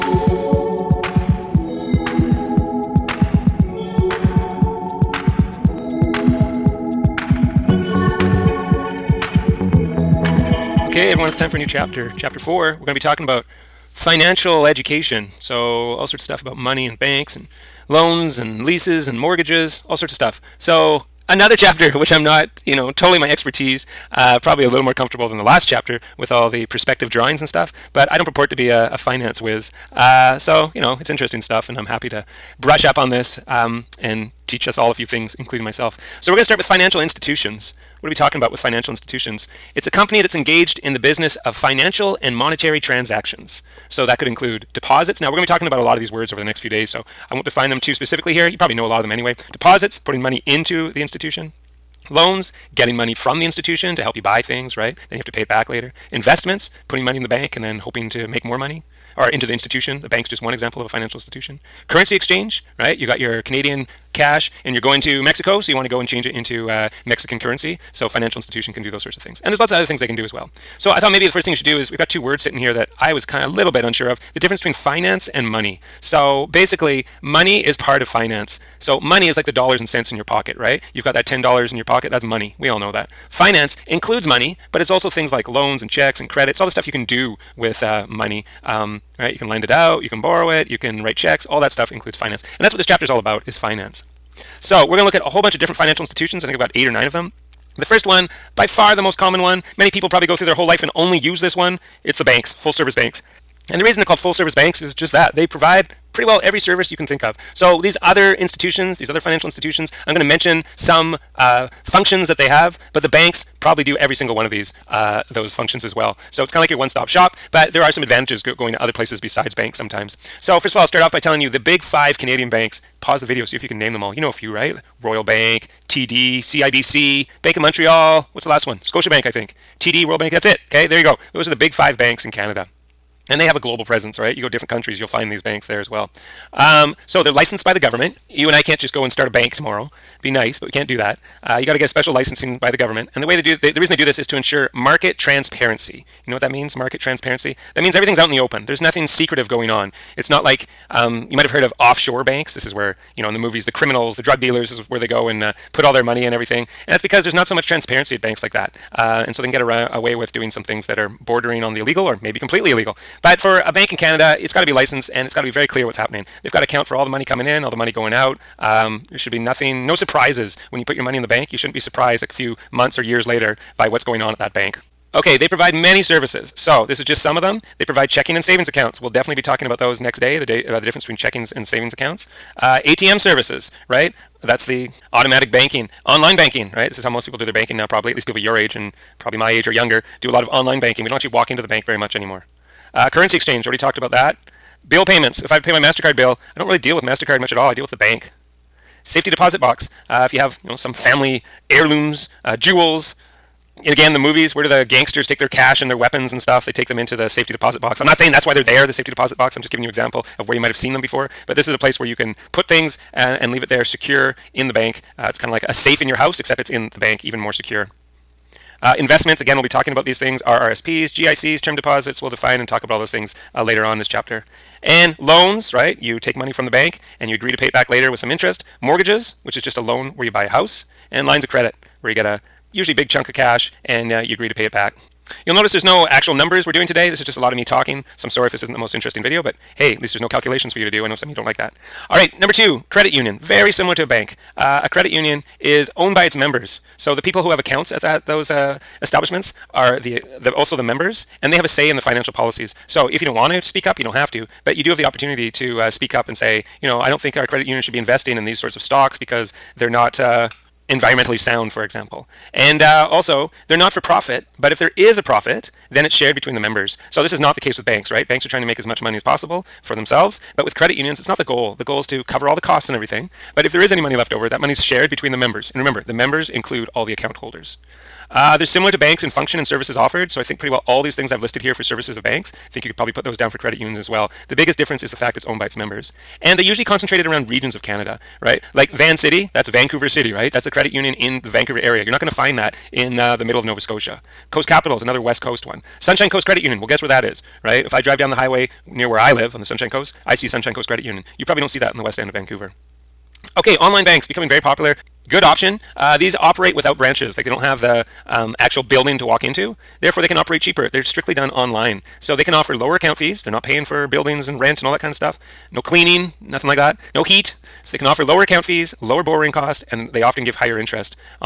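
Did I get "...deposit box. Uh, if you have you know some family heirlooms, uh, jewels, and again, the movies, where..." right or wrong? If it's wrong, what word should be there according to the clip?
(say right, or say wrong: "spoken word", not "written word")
right.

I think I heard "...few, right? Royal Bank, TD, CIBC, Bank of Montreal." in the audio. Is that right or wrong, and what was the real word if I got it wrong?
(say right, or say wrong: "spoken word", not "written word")
right.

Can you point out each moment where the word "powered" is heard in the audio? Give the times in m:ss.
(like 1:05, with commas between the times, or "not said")
not said.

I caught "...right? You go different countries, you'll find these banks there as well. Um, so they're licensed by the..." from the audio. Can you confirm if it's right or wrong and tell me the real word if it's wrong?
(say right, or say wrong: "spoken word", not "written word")
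right.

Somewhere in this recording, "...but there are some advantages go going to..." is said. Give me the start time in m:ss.
1:57.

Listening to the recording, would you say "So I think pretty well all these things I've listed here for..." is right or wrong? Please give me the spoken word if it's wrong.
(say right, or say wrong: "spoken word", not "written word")
right.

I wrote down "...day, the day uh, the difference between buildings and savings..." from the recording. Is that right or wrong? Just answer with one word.
wrong.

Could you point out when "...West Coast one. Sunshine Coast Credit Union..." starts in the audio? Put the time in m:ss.
4:55.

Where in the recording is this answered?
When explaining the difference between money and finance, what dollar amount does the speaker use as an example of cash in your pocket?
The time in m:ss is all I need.
1:21.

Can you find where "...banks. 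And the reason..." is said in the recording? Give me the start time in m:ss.
1:42.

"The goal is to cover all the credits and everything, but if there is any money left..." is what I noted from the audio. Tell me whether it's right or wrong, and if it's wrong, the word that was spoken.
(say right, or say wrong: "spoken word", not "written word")
wrong: "costs", not "credits".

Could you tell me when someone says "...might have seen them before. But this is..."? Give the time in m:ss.
3:30.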